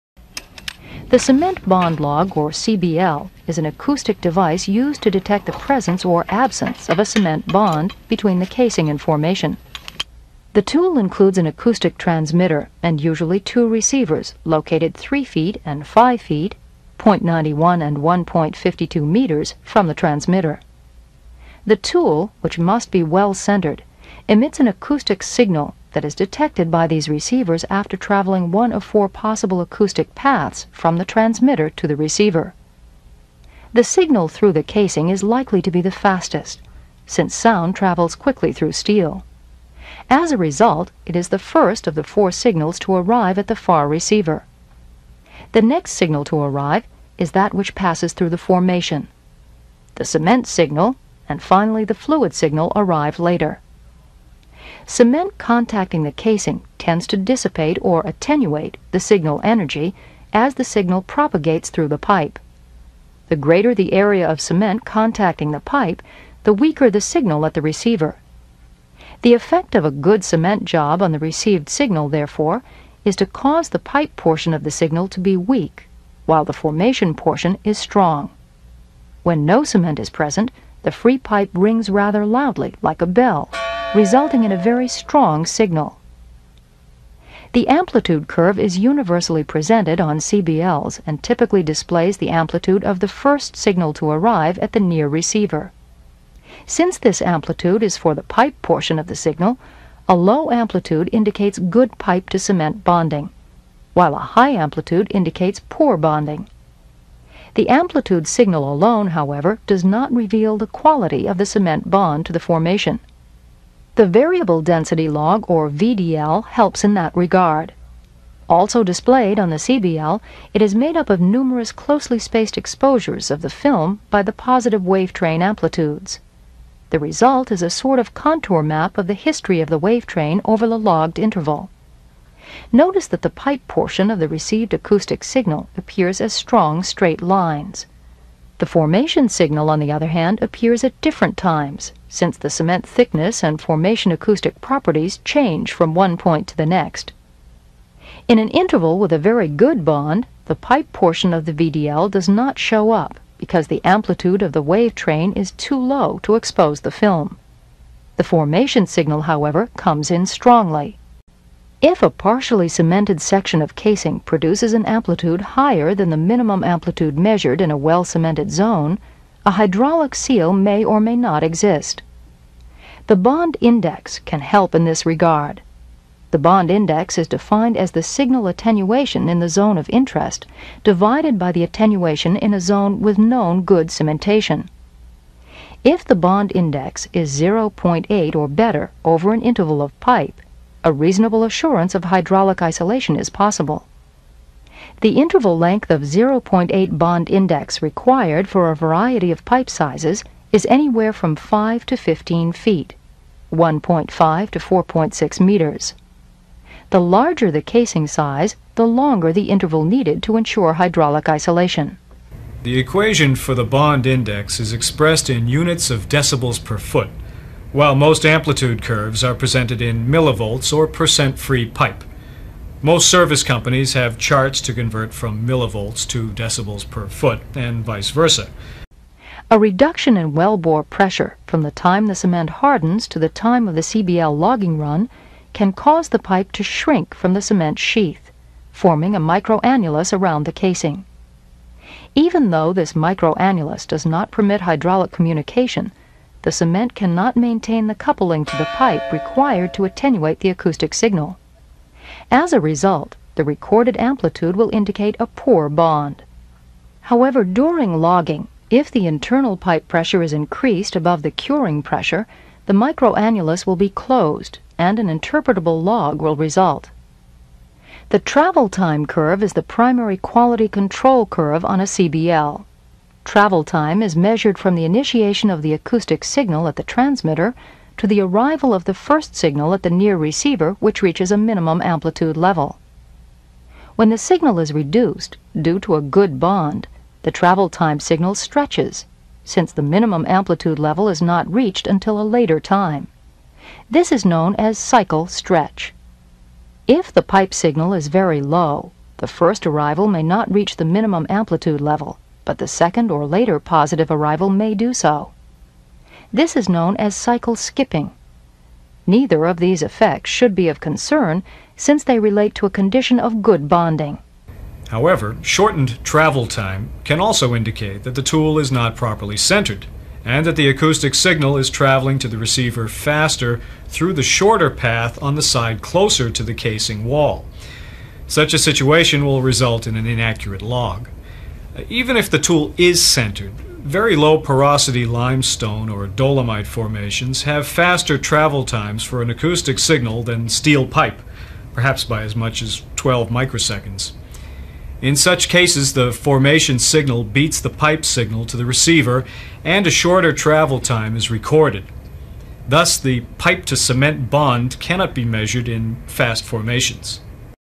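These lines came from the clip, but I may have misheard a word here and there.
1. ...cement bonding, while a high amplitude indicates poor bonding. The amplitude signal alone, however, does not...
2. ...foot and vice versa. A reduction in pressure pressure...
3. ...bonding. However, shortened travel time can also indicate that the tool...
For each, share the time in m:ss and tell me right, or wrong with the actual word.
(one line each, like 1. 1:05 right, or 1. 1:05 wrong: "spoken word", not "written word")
1. 1:42 right
2. 3:47 wrong: "wellbore", not "pressure"
3. 5:13 right.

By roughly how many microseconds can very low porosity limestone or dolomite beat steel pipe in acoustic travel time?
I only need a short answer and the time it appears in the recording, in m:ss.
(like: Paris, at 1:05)
12 microseconds, at 5:42.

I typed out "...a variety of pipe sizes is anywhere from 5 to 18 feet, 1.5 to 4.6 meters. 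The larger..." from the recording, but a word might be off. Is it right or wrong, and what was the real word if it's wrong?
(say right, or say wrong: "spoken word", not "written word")
wrong: "15", not "18".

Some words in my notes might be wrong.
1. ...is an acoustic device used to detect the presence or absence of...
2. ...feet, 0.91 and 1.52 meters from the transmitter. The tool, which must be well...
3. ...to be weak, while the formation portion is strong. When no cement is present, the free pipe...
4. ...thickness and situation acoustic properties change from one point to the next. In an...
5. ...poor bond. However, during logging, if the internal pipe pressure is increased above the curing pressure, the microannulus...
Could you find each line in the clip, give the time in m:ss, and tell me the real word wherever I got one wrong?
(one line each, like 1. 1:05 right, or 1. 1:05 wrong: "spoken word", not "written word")
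1. 0:03 right
2. 0:16 right
3. 1:15 right
4. 2:22 wrong: "formation", not "situation"
5. 4:15 right.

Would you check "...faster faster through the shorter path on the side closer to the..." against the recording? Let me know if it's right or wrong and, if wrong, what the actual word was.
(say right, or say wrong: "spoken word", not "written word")
wrong: "receiver", not "faster".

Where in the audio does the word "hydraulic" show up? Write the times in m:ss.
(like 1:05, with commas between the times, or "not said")
2:49, 3:12, 3:30, 4:04.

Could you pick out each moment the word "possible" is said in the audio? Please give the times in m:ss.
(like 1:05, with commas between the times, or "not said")
0:29, 3:13.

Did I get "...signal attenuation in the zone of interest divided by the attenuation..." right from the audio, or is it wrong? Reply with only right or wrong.
right.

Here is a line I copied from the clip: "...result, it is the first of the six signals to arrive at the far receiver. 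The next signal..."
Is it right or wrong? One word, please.
wrong.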